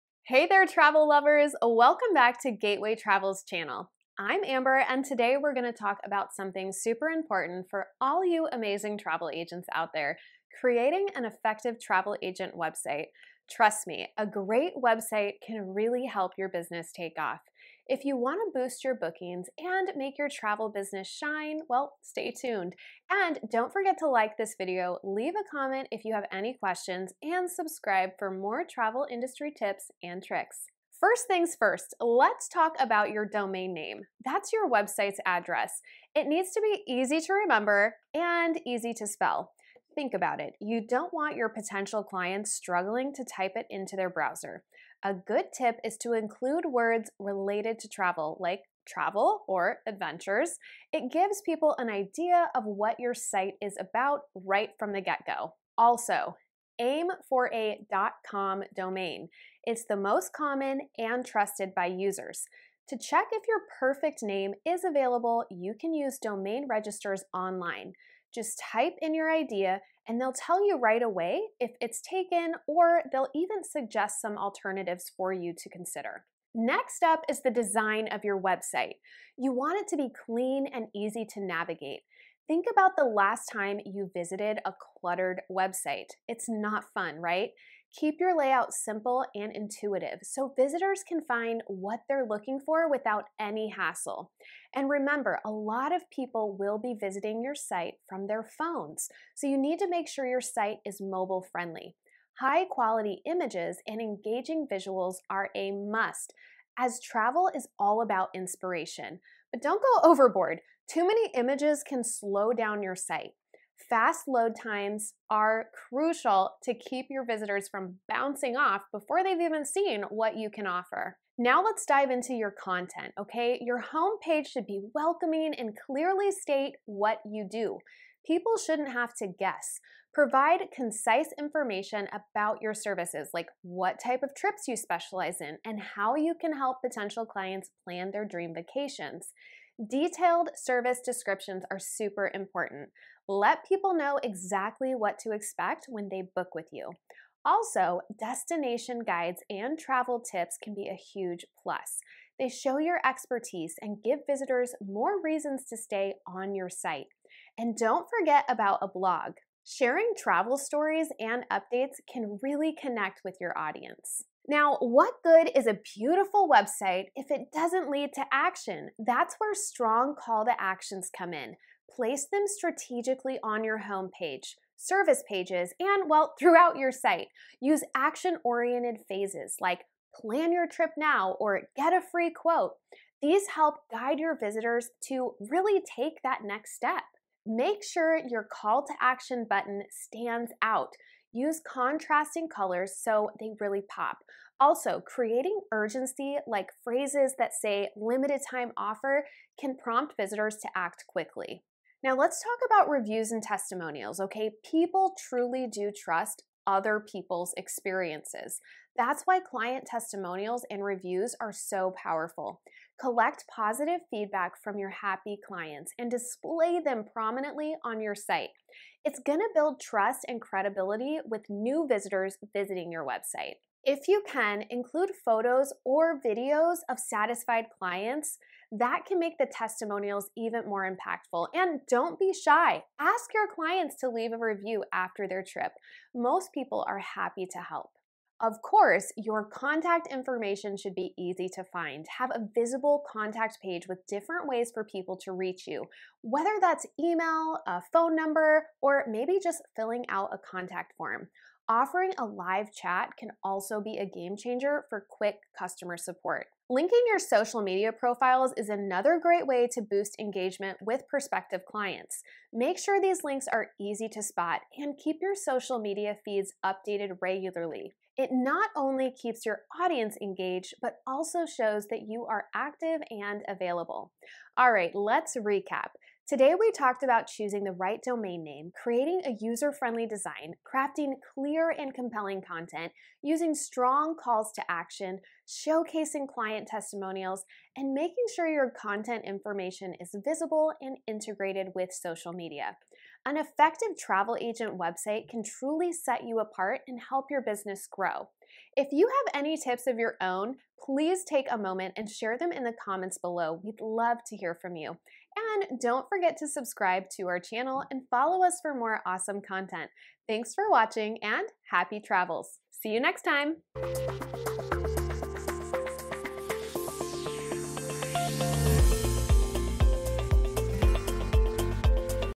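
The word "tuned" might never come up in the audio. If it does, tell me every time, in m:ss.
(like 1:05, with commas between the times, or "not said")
0:22.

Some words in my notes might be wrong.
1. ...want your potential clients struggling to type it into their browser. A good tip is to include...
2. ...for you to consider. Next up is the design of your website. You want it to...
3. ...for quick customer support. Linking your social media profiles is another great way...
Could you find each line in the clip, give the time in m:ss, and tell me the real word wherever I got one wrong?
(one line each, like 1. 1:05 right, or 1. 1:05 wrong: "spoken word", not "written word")
1. 0:41 right
2. 1:15 right
3. 4:14 right.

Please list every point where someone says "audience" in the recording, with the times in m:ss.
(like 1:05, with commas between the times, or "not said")
2:43, 4:29.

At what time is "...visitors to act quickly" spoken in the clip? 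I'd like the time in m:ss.
3:20.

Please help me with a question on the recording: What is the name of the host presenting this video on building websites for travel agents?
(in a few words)
Amber.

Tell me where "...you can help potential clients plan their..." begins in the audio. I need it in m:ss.
2:16.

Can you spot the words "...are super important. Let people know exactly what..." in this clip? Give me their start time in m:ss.
2:21.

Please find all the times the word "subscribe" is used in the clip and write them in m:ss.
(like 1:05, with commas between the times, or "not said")
0:27, 5:06.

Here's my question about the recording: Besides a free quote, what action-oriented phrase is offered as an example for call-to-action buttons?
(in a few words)
Plan your trip now.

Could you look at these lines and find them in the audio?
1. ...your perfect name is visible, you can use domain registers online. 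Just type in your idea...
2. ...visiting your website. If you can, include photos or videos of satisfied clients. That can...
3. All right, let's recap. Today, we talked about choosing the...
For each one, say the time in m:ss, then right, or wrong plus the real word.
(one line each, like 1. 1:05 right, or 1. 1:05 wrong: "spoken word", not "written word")
1. 1:03 wrong: "available", not "visible"
2. 3:42 right
3. 4:34 right.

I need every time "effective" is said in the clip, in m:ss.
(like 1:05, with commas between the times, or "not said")
0:11, 4:53.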